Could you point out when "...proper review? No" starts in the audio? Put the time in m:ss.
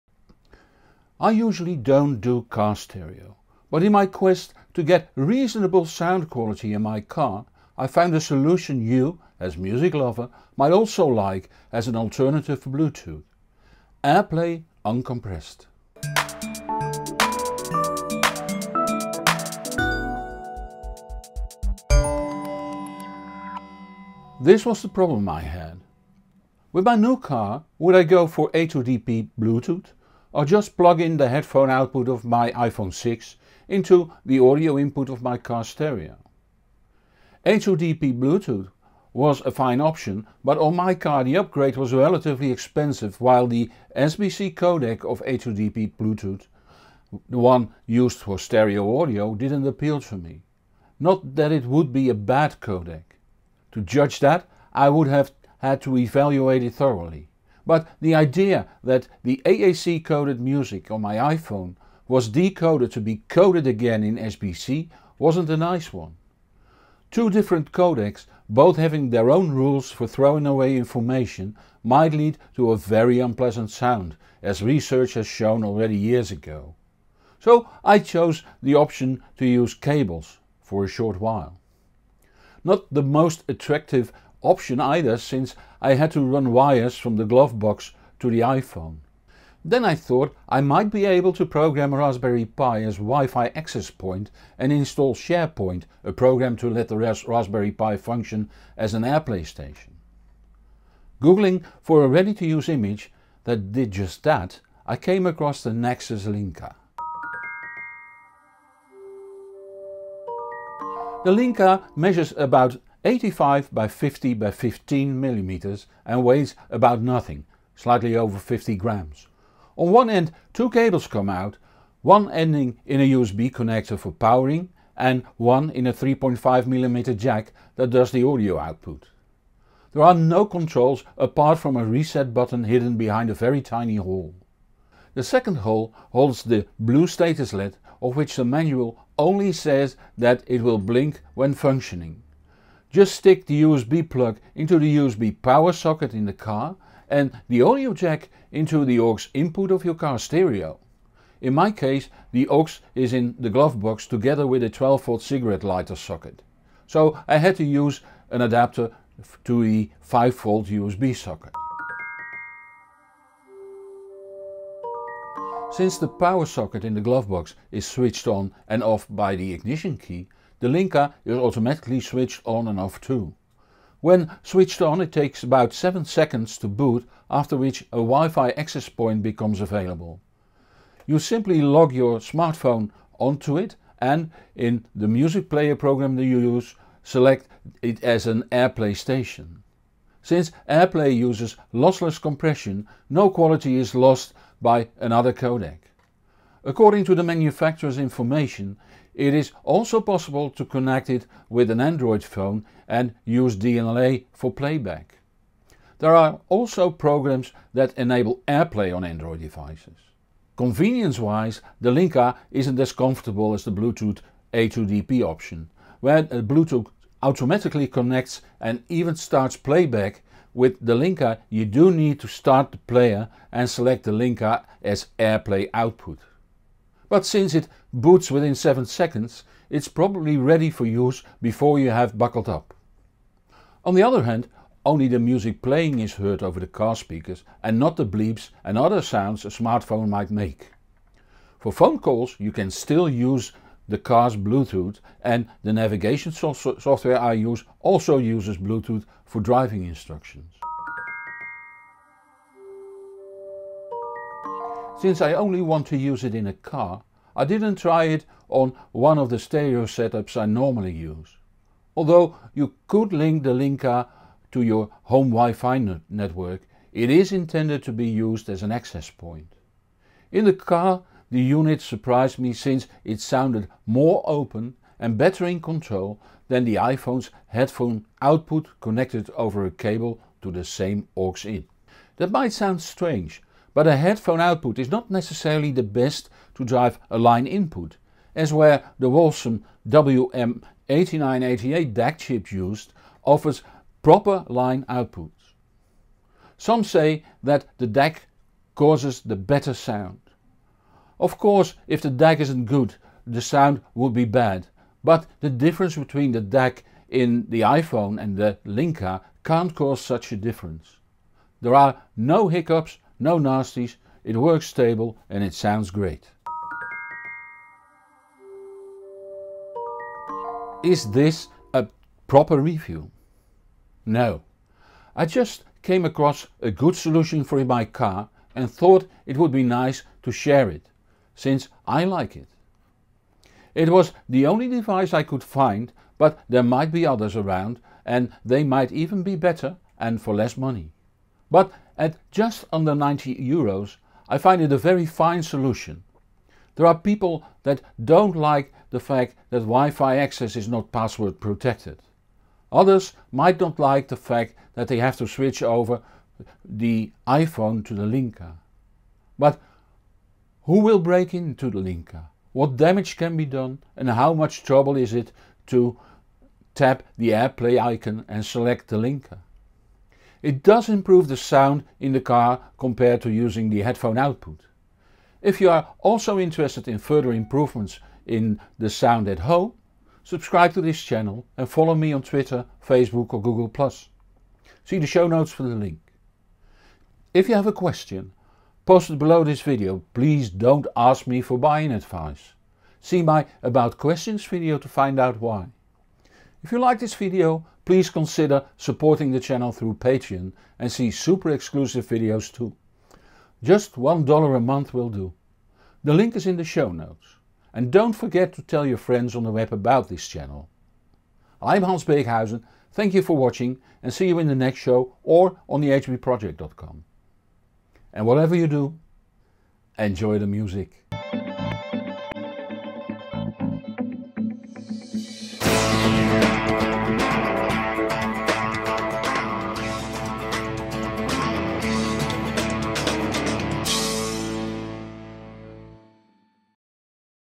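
5:22.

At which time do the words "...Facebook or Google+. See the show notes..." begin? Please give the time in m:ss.
6:22.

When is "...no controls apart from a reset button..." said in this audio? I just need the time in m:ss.
2:10.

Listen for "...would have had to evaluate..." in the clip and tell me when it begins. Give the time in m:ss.
0:54.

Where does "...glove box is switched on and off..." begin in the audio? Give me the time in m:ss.
2:47.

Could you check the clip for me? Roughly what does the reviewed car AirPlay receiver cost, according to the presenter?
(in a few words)
Just under 90 euros.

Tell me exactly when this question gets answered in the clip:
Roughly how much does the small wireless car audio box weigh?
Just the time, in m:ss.
1:57.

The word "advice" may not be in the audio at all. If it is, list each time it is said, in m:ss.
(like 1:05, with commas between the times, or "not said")
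6:31.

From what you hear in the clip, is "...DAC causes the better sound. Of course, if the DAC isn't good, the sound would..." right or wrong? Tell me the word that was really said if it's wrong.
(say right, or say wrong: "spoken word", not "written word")
right.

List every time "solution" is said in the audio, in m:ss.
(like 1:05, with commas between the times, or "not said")
0:08, 5:26, 5:45.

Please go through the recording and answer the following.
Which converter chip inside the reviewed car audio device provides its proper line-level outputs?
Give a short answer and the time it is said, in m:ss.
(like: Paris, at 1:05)
Wolfson WM8988, at 4:49.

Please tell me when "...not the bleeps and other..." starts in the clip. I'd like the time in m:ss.
3:57.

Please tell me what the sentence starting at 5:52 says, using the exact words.
Others might not like the fact that they have to switch over the iPhone to the Linka.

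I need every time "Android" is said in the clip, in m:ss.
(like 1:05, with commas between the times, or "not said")
3:21, 3:29.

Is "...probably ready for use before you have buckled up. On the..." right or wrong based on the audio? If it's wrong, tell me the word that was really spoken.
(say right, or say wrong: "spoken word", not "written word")
right.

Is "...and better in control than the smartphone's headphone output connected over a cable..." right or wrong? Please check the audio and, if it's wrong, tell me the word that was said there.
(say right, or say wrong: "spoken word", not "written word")
wrong: "iPhone", not "smartphone".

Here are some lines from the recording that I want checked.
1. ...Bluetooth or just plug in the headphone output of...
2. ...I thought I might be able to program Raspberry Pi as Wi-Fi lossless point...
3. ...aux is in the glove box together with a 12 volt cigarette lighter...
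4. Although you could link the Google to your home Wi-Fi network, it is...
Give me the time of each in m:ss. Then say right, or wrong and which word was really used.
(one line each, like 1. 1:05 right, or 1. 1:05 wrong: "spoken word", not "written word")
1. 0:29 right
2. 1:29 wrong: "access", not "lossless"
3. 2:32 right
4. 4:21 wrong: "Linka", not "Google".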